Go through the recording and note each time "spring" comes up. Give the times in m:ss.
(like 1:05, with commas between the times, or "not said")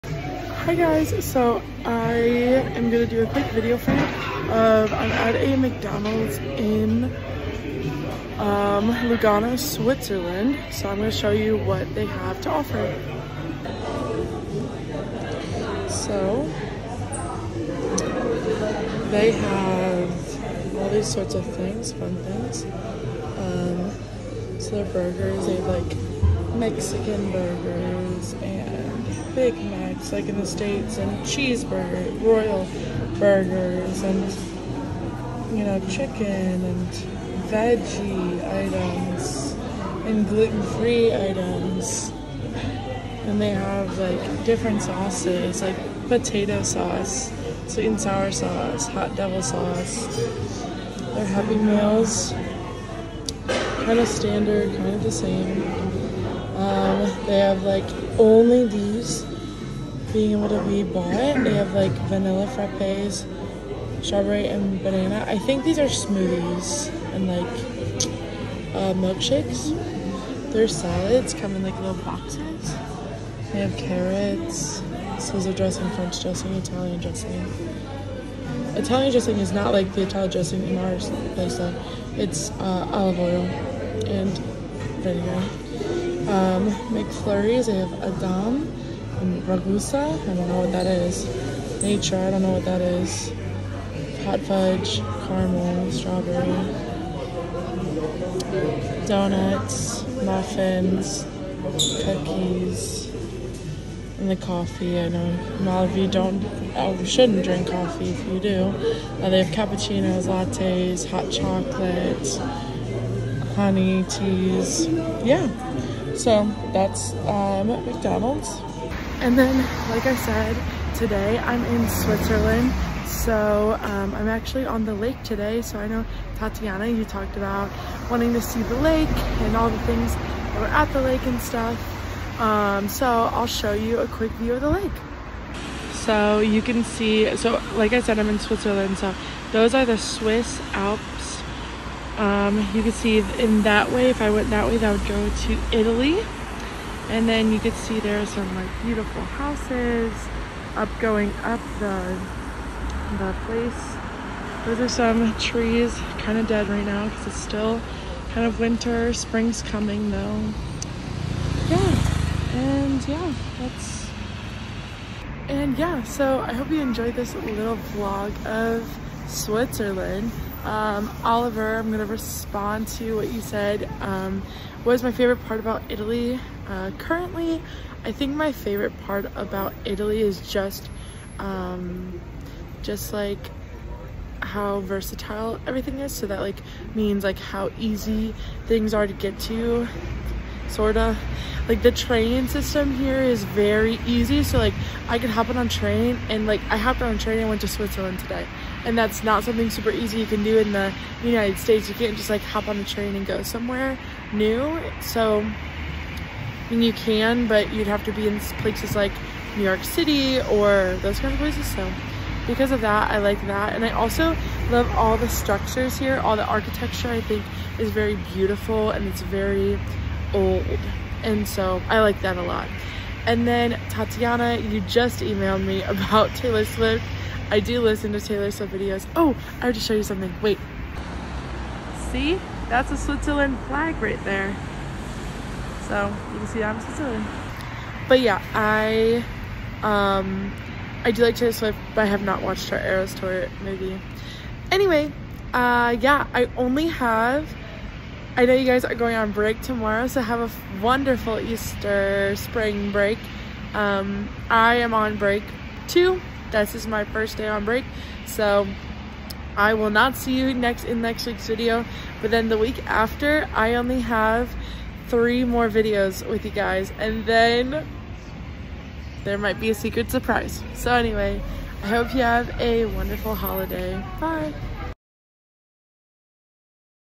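2:39, 4:12.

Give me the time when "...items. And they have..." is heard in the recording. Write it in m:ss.
0:41.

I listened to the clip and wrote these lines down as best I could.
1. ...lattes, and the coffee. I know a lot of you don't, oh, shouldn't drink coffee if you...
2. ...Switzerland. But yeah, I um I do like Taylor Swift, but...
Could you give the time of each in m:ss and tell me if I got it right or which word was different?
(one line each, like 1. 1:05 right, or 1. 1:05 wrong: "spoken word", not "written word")
1. 1:42 wrong: "cookies", not "lattes"
2. 3:56 right.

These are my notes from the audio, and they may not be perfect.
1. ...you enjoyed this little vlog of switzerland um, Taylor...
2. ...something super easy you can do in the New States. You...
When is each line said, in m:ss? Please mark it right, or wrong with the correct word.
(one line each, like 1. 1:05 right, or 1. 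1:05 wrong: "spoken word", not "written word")
1. 2:46 wrong: "Oliver", not "Taylor"
2. 3:19 wrong: "United", not "New".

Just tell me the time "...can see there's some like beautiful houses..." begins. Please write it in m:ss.
2:27.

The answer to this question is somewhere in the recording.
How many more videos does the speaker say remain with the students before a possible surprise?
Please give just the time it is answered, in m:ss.
4:25.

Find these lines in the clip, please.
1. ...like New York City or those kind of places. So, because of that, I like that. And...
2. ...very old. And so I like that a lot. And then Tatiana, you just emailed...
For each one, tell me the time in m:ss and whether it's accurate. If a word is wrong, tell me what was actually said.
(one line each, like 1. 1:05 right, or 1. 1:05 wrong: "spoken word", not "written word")
1. 3:28 right
2. 3:39 right.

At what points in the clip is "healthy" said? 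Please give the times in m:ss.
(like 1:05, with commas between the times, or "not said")
not said.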